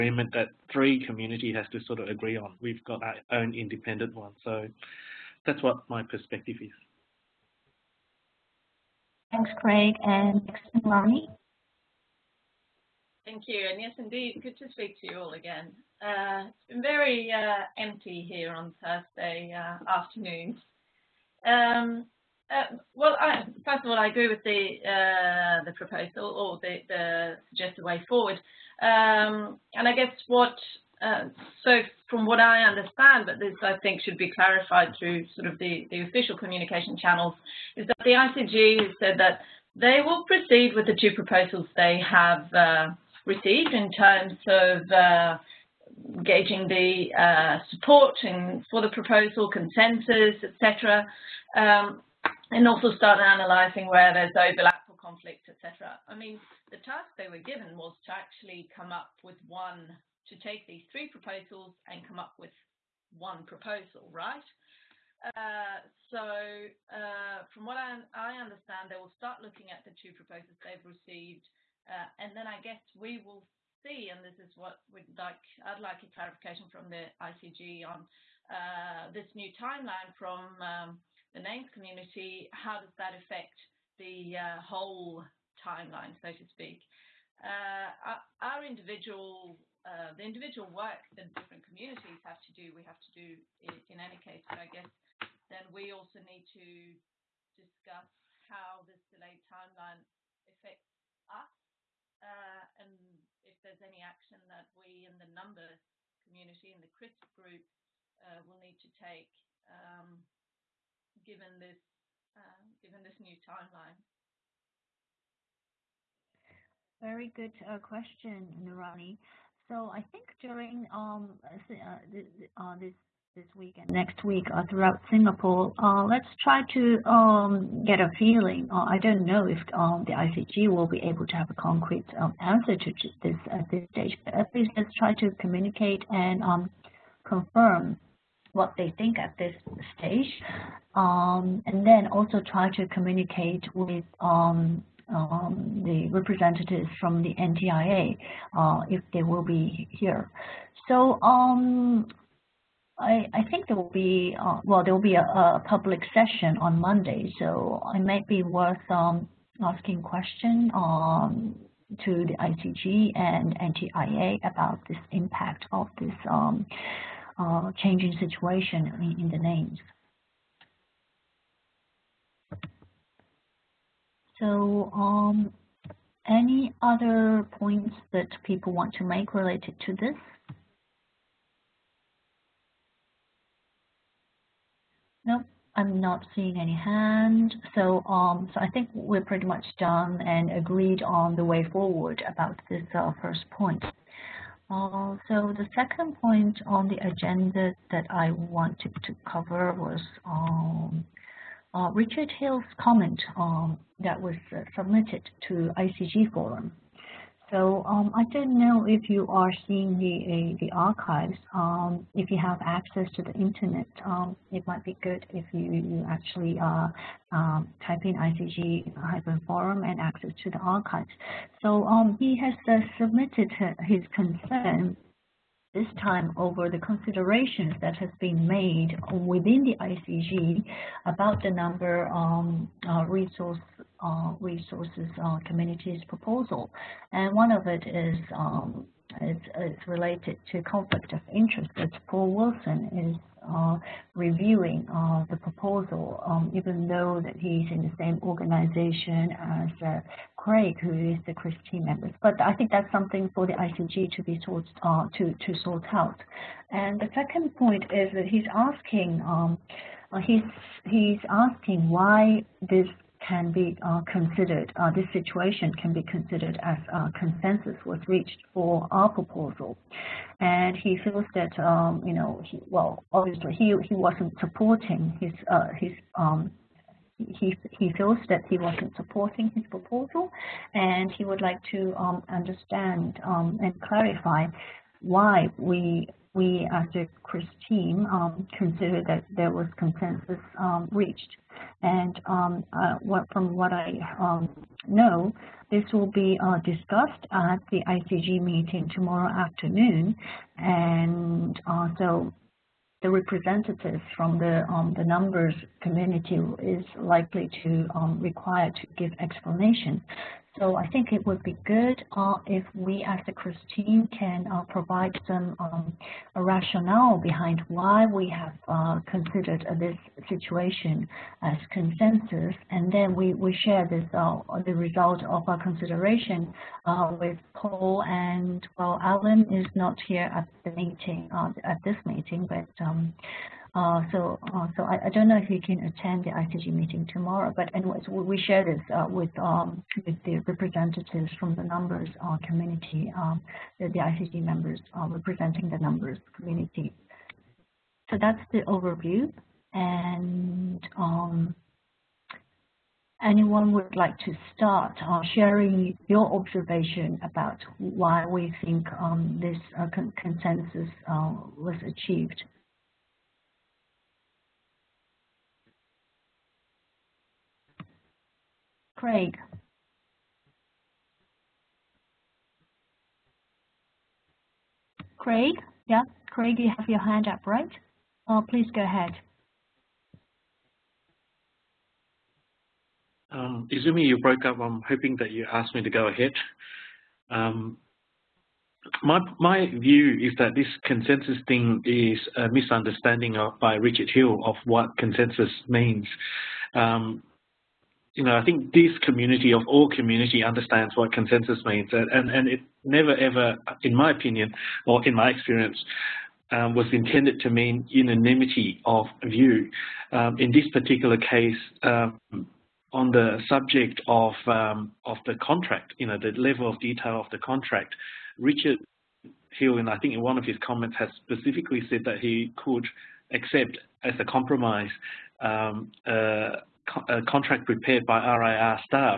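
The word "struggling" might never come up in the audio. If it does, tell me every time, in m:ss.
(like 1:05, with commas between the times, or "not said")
not said.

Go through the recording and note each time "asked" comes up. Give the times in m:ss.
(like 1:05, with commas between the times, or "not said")
6:25.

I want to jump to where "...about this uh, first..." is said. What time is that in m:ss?
3:12.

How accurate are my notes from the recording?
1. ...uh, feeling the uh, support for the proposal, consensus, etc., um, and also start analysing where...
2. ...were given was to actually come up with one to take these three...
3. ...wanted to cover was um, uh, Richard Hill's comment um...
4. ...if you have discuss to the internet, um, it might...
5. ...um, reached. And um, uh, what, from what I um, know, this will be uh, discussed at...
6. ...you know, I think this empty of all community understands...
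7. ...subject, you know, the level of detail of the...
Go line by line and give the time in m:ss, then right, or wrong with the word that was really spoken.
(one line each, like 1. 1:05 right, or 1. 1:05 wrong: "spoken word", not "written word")
1. 0:44 wrong: "gauging", not "feeling"
2. 0:57 right
3. 3:18 right
4. 3:32 wrong: "access", not "discuss"
5. 4:50 right
6. 6:38 wrong: "community", not "empty"
7. 6:55 wrong: "contract", not "subject".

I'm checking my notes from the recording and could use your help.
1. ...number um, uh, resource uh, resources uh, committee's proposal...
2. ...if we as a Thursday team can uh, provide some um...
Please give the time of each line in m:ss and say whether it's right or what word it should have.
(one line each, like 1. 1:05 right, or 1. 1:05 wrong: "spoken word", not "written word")
1. 3:51 right
2. 5:12 wrong: "CRISP", not "Thursday".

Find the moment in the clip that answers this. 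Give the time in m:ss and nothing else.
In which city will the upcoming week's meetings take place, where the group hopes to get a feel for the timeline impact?
2:05.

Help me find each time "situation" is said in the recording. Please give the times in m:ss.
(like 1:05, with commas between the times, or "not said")
2:48, 4:25, 5:20.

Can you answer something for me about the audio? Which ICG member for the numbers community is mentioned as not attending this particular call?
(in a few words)
Alan.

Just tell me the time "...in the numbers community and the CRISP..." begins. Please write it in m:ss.
1:45.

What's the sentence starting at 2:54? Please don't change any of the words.
So um, any other points that people want to make related to this?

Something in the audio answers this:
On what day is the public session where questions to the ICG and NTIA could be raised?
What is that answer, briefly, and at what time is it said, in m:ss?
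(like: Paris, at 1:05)
Monday, at 2:36.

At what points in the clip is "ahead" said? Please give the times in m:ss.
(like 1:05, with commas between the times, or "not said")
6:18, 6:26.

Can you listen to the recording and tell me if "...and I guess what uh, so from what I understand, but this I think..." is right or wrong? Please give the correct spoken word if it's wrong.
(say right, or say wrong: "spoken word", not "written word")
right.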